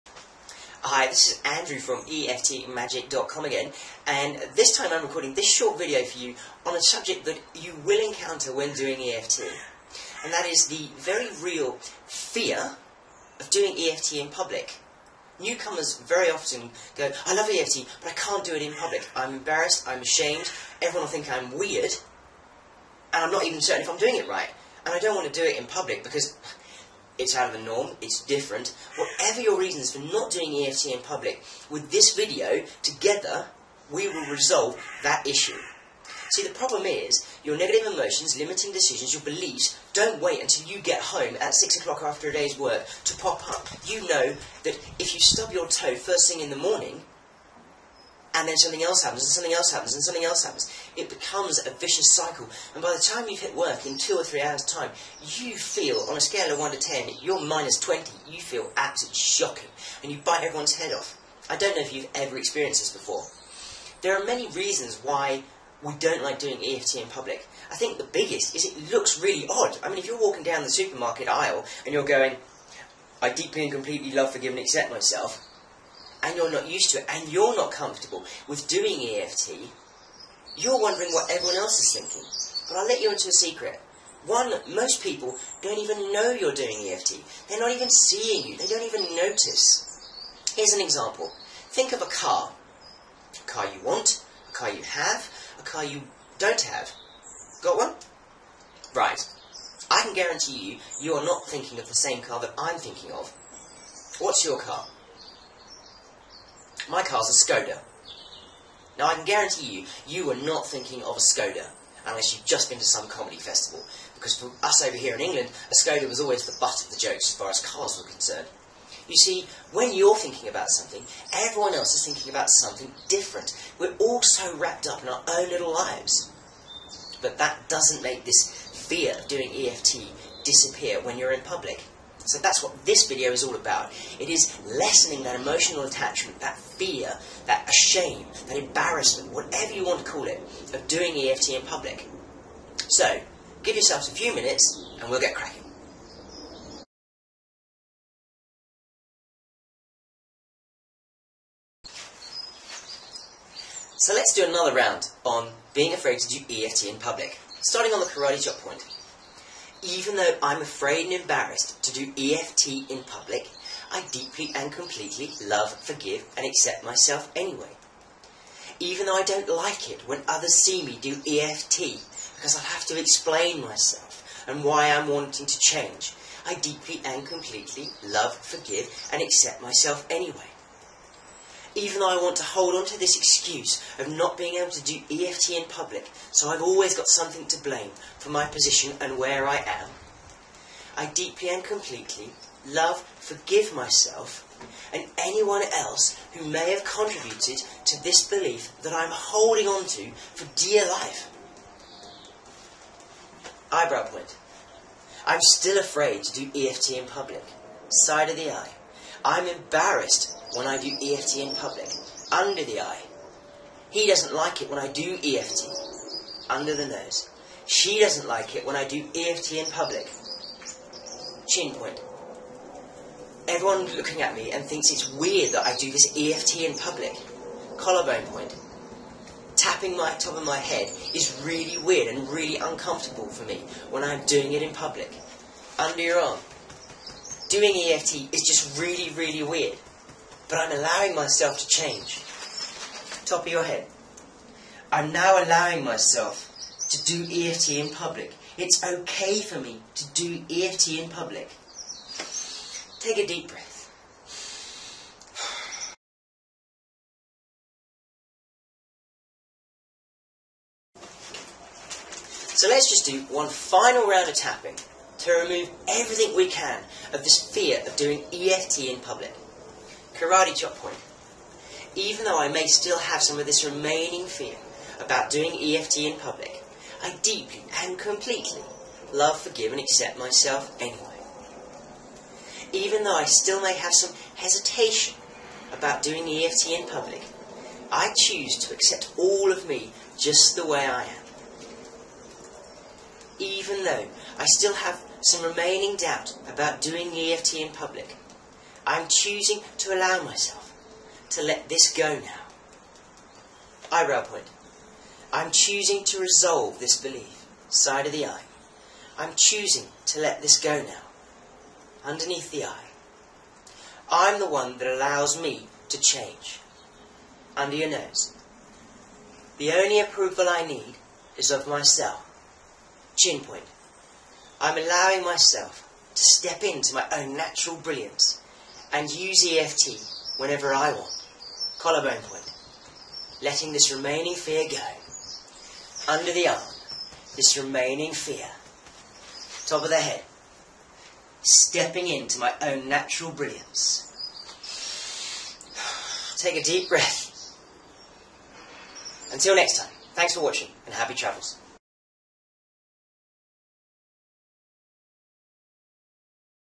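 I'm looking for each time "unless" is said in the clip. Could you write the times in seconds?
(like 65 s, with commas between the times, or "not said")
112 s.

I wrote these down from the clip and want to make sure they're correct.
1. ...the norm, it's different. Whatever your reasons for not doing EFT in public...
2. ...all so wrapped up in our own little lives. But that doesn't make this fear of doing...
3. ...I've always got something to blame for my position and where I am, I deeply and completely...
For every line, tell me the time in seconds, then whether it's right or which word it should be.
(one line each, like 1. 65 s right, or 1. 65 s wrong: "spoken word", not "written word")
1. 27 s right
2. 123 s right
3. 186 s right.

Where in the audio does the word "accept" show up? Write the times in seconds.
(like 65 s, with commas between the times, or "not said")
74 s, 166 s, 179 s, 279 s, 288 s.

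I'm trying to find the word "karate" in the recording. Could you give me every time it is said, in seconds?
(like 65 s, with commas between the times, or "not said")
158 s, 270 s.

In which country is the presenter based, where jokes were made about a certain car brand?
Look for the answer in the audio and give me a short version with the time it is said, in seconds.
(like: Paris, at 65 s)
England, at 115 s.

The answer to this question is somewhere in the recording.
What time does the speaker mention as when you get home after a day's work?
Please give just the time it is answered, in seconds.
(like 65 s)
41 s.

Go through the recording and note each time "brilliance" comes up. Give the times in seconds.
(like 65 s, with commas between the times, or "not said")
327 s, 343 s.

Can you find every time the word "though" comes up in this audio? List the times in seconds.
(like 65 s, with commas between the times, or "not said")
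160 s, 169 s, 182 s, 272 s, 283 s, 293 s.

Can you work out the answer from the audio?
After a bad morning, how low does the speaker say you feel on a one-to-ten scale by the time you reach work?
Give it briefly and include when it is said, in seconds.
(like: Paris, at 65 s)
minus 20, at 57 s.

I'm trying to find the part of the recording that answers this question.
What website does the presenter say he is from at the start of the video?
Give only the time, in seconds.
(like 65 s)
2 s.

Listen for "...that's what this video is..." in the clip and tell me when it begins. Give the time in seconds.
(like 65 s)
132 s.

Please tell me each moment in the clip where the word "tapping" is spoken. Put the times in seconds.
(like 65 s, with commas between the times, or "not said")
229 s, 264 s.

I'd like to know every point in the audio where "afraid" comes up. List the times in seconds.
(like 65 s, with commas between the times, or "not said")
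155 s, 160 s, 205 s.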